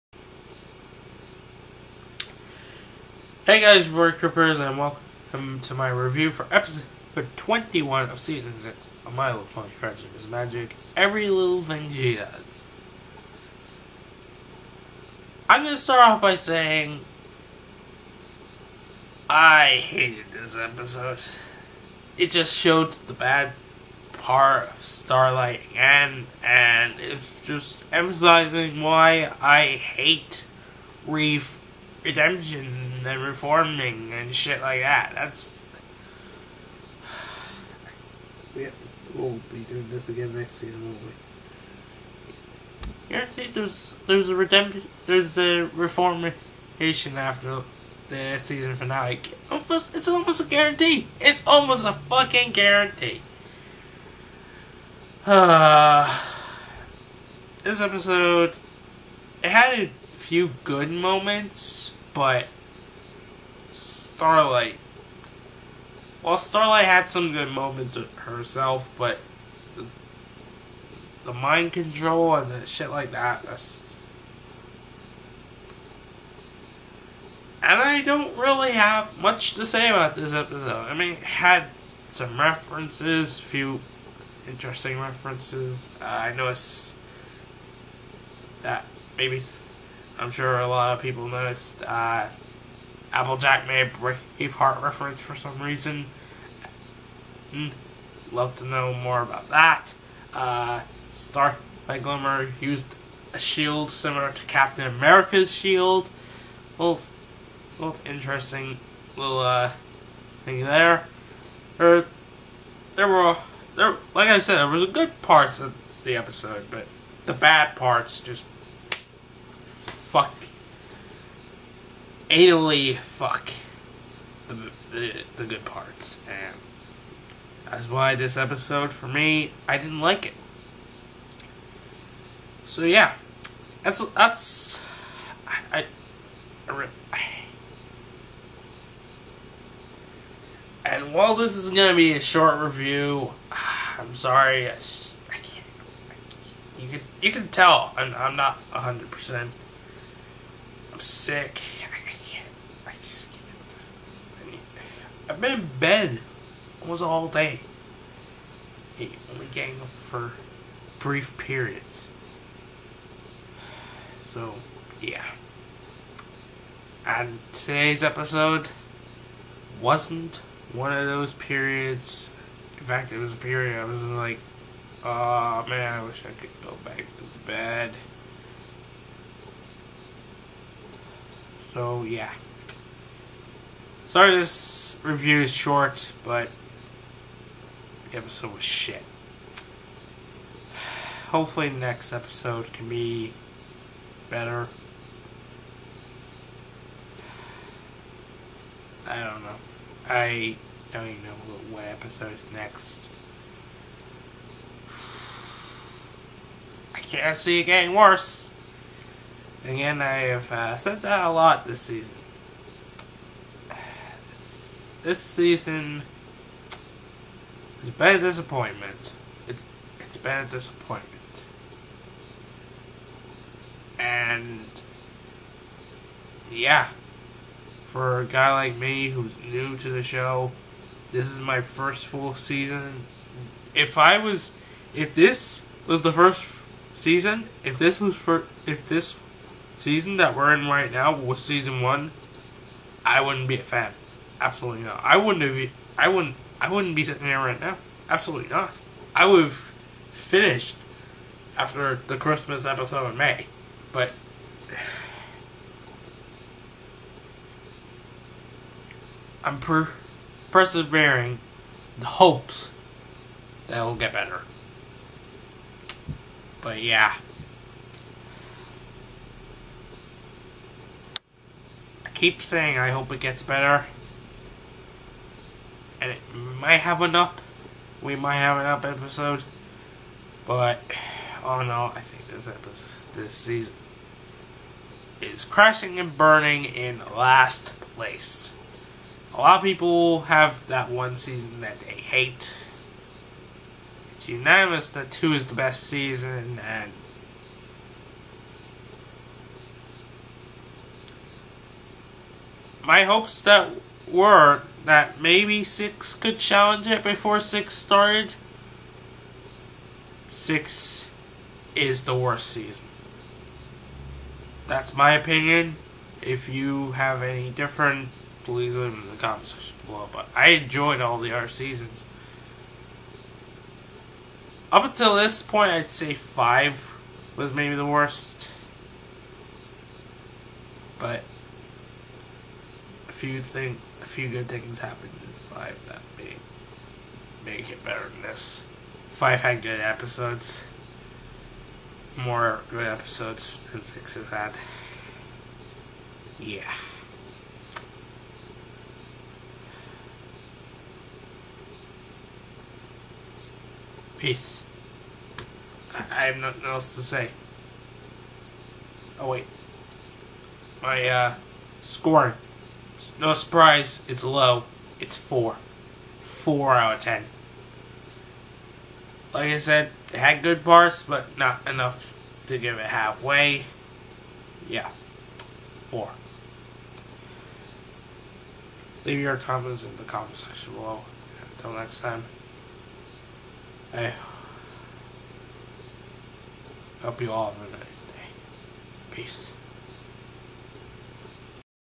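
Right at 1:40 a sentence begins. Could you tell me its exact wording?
Uh, Star Starlight Glimmer used a shield similar to Captain America's shield.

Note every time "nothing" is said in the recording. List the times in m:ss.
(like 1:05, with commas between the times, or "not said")
5:56.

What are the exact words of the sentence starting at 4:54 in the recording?
It's unanimous that two is the best season, and my hopes that were that maybe six could challenge it before six started.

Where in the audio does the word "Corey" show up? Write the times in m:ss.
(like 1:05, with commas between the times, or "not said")
0:03.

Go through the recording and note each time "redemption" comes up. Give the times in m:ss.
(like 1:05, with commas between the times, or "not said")
0:32, 0:44.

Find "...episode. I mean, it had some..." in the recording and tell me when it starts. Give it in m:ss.
1:20.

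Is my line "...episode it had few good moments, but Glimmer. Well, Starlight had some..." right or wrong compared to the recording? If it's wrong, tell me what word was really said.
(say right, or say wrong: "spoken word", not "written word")
wrong: "Starlight", not "Glimmer".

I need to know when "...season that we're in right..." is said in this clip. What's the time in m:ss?
3:59.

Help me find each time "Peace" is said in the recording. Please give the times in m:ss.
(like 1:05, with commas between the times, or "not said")
5:54, 6:29.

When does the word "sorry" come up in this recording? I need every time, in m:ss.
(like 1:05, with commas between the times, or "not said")
2:24, 3:04.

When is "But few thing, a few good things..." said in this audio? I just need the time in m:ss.
5:30.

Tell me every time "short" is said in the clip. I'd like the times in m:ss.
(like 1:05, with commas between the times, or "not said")
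2:22, 3:05.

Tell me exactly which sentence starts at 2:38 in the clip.
And only getting up for brief periods.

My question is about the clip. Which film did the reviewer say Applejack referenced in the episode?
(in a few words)
Braveheart.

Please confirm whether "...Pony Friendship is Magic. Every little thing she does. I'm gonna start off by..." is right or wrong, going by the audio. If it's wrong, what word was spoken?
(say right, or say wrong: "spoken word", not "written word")
right.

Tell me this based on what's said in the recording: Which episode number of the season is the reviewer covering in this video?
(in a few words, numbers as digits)
21.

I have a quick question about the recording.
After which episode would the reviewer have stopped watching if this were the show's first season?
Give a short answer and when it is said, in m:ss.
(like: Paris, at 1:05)
The Christmas episode, at 4:12.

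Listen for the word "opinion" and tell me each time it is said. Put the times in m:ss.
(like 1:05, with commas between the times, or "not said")
5:15.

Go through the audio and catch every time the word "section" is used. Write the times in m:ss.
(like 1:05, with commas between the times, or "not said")
5:19, 6:20.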